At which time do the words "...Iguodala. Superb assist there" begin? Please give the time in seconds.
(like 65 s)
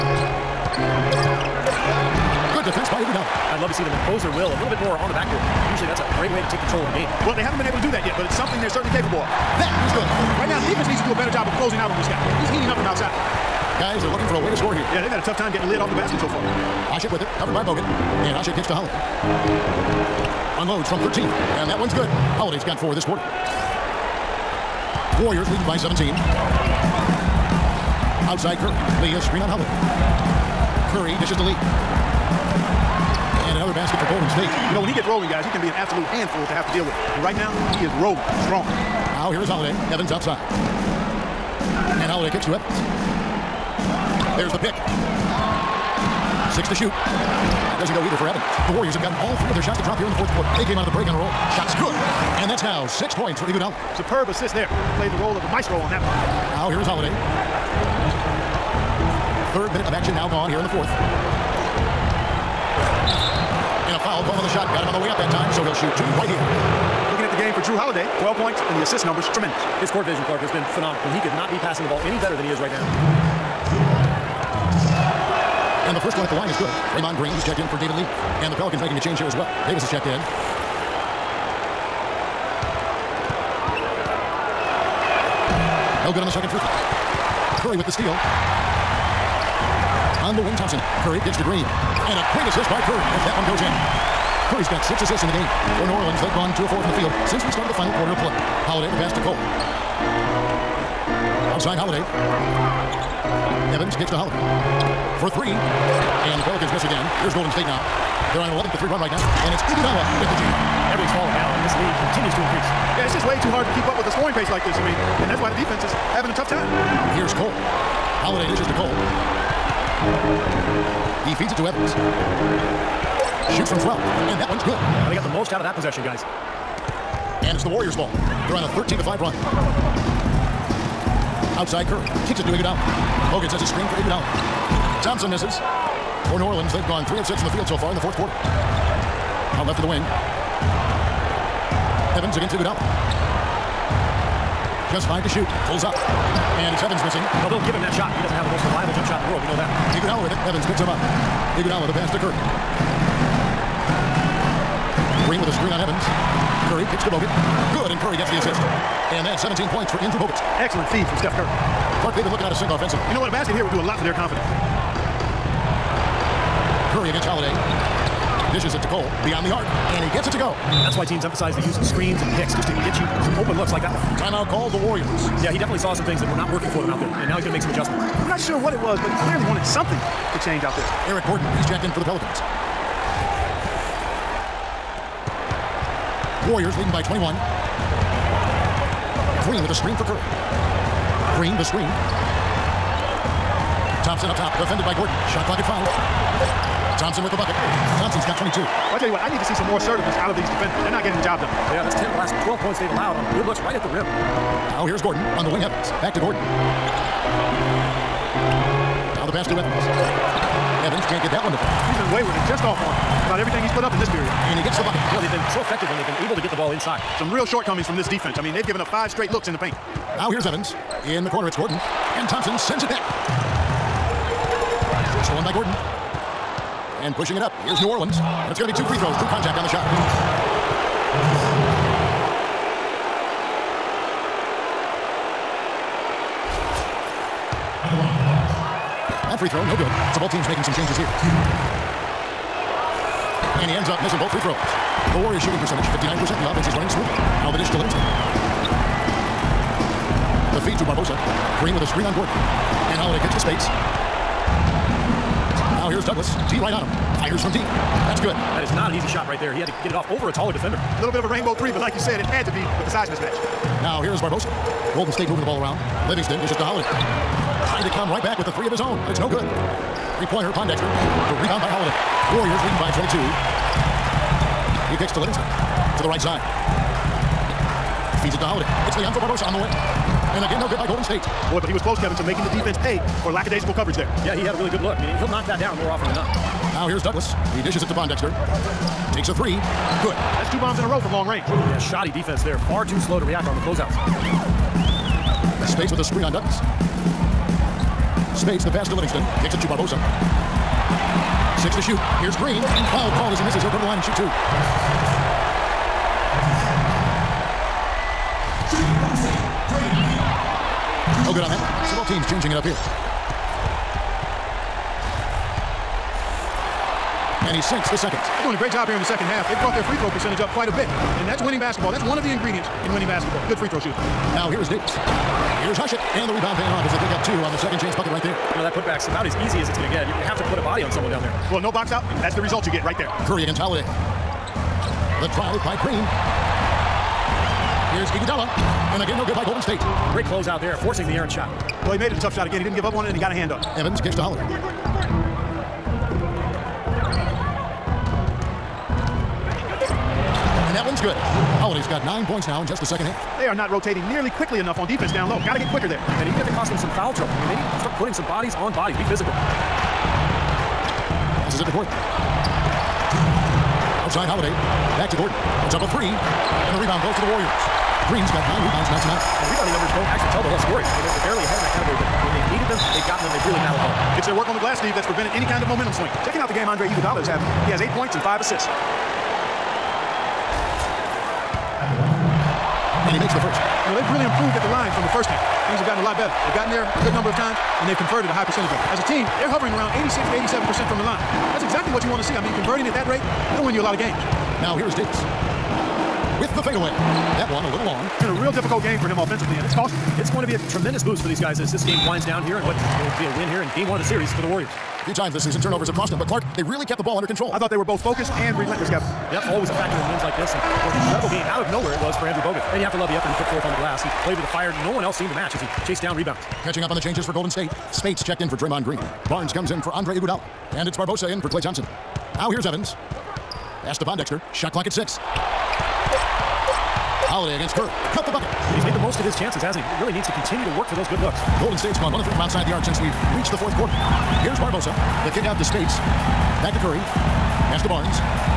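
53 s.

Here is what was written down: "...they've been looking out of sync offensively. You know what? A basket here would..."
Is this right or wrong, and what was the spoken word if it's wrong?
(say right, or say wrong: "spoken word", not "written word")
right.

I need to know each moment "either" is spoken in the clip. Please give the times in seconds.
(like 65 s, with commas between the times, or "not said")
47 s.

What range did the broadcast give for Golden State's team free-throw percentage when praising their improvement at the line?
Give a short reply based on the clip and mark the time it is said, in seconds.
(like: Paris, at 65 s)
86 to 87%, at 390 s.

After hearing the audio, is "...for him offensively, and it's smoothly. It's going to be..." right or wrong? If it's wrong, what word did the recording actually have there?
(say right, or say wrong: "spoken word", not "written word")
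wrong: "costly", not "smoothly".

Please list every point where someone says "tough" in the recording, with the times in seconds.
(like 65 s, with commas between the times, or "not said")
15 s, 116 s, 342 s.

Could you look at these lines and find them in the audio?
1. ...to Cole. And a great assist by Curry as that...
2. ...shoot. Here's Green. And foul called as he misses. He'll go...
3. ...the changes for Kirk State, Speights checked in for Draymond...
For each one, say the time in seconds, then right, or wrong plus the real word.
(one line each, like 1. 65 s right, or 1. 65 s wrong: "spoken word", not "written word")
1. 91 s wrong: "Green", not "Cole"
2. 301 s right
3. 416 s wrong: "Golden", not "Kirk".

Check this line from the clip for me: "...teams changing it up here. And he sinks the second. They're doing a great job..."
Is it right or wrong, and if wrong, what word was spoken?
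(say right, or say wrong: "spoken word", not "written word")
right.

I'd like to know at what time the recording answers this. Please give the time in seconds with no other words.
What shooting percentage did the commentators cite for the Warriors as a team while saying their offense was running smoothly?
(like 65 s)
245 s.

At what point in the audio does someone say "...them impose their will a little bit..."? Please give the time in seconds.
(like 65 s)
3 s.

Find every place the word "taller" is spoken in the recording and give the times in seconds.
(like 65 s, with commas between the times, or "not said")
260 s.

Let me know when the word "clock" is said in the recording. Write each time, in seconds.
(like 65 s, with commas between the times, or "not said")
195 s, 424 s.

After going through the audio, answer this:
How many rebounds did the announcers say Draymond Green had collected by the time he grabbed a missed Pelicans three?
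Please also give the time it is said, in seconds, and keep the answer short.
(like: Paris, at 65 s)
9, at 368 s.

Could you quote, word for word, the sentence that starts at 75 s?
And the first one at the line is good.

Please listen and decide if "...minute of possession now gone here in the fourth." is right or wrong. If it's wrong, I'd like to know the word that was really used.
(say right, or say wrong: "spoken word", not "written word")
wrong: "action", not "possession".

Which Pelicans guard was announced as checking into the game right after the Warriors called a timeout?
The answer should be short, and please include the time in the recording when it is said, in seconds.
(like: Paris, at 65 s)
Eric Gordon, at 181 s.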